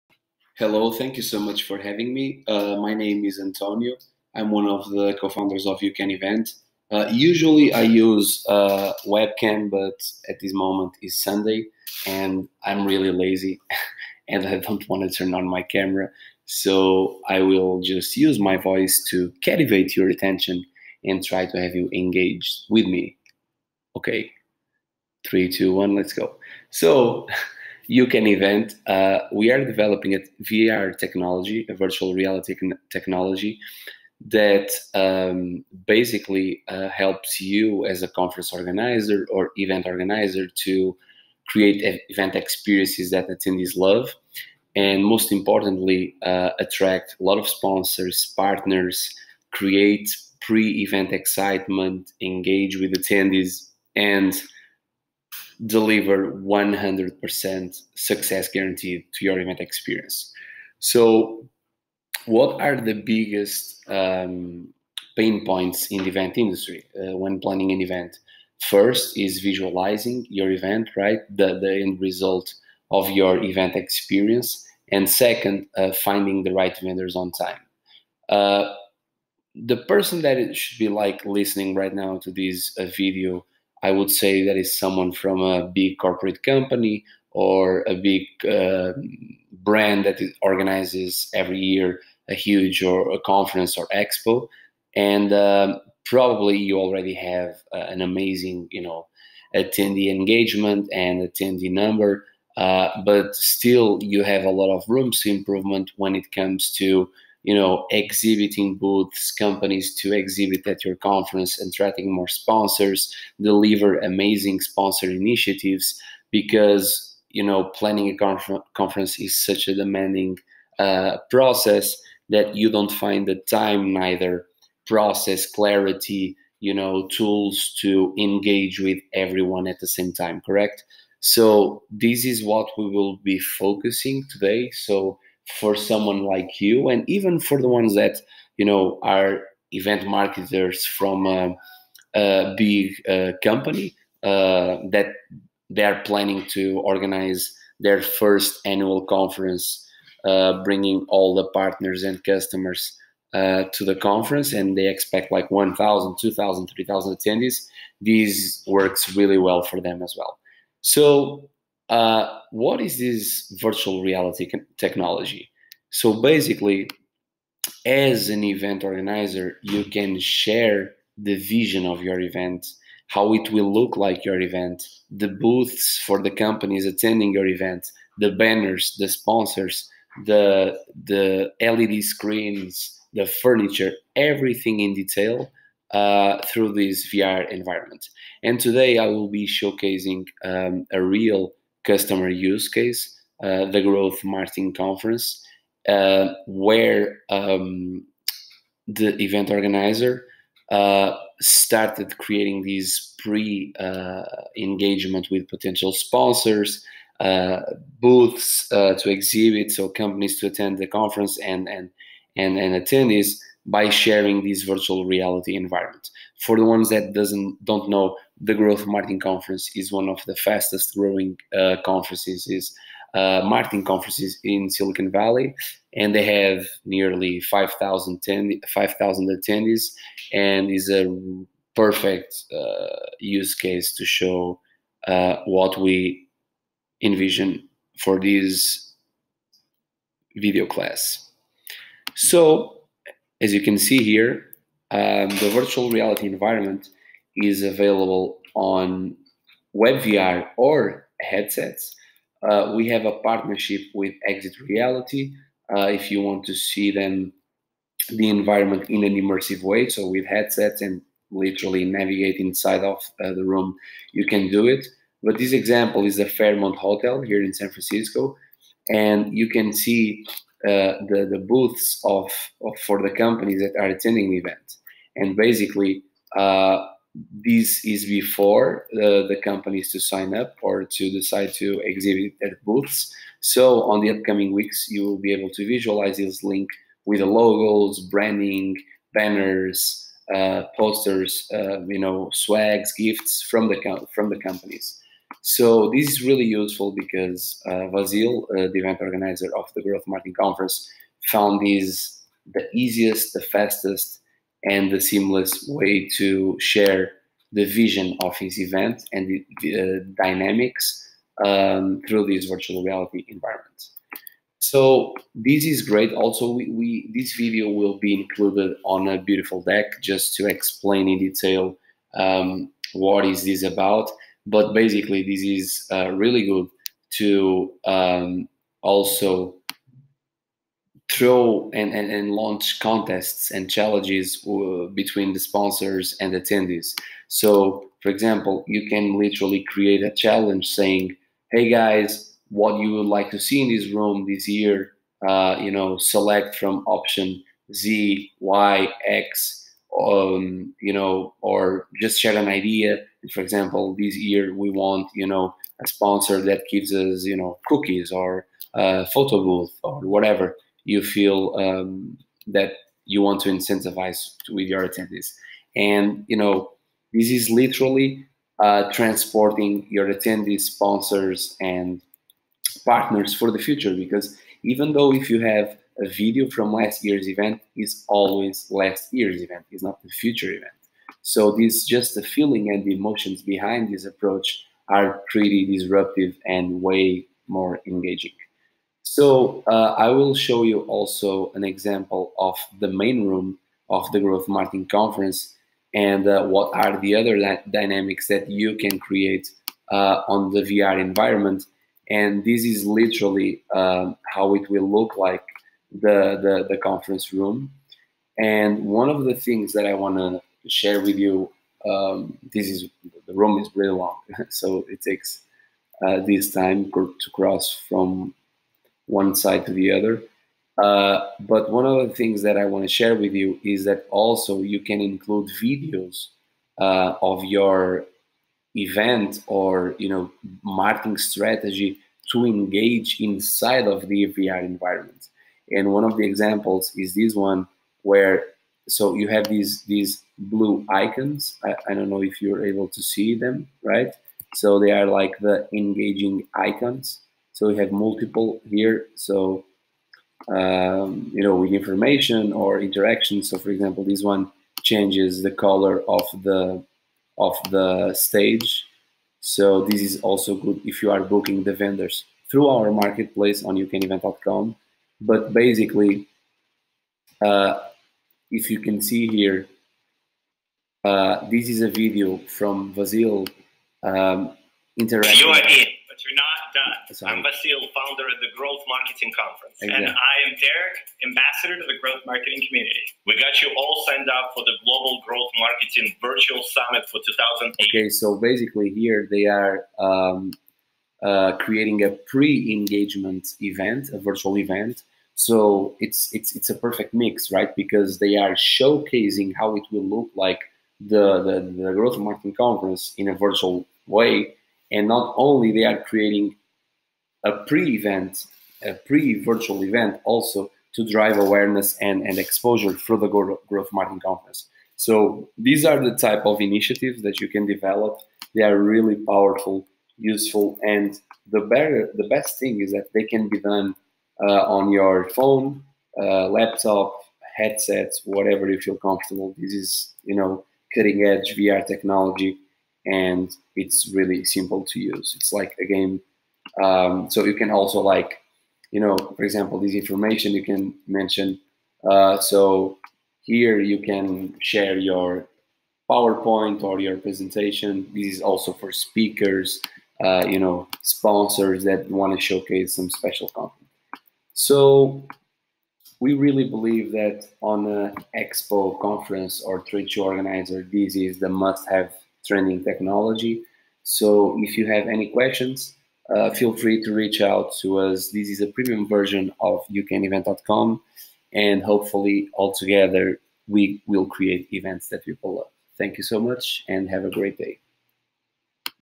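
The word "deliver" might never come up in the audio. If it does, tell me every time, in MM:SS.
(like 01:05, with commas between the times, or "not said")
00:55, 01:53.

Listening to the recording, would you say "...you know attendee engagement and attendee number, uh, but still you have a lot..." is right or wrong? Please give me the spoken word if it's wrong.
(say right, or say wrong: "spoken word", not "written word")
right.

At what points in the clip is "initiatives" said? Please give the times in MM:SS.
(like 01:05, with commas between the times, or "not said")
01:55, 08:36.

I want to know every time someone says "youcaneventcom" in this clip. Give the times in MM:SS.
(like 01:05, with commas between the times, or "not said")
07:43, 09:29.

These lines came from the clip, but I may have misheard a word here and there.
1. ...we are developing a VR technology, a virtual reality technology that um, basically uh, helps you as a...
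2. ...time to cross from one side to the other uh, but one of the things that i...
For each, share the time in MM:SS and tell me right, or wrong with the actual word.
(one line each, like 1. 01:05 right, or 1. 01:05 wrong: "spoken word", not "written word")
1. 00:29 right
2. 06:56 right.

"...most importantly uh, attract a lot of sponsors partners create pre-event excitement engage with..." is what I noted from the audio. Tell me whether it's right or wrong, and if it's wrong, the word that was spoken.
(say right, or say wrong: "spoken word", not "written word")
right.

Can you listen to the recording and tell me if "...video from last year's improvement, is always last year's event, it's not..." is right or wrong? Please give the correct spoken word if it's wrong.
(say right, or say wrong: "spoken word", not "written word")
wrong: "event", not "improvement".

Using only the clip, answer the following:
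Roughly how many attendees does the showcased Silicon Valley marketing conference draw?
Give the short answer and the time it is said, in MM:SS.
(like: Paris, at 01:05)
5,000, at 03:47.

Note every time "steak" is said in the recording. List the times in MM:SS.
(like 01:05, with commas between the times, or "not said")
not said.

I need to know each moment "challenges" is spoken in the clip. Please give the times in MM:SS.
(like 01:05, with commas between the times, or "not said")
05:33, 05:40.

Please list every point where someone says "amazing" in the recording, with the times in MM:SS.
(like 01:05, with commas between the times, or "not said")
01:38, 01:53.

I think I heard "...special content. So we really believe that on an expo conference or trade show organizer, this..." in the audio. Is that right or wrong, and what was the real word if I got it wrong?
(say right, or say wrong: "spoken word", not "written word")
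right.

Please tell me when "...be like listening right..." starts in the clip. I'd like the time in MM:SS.
01:20.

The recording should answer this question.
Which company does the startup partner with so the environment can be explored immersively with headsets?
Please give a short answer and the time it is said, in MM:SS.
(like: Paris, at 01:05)
Exit Reality, at 04:14.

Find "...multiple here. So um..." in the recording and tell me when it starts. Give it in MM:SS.
07:27.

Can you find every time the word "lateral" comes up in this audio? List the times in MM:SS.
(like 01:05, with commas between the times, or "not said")
not said.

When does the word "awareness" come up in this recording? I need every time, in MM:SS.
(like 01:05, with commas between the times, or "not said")
08:31.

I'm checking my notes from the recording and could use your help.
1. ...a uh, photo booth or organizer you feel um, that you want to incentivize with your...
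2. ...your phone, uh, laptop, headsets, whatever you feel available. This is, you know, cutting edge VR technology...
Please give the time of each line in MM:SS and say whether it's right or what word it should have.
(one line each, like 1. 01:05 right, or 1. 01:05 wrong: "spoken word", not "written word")
1. 05:58 wrong: "whatever", not "organizer"
2. 08:44 wrong: "comfortable", not "available".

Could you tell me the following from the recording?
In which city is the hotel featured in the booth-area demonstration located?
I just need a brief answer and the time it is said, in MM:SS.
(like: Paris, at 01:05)
San Francisco, at 04:27.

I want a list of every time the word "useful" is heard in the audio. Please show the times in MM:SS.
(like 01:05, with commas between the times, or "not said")
04:56, 08:40.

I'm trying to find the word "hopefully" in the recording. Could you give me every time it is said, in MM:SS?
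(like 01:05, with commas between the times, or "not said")
09:31.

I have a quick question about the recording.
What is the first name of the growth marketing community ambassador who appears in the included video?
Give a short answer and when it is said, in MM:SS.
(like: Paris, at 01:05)
Derek, at 08:00.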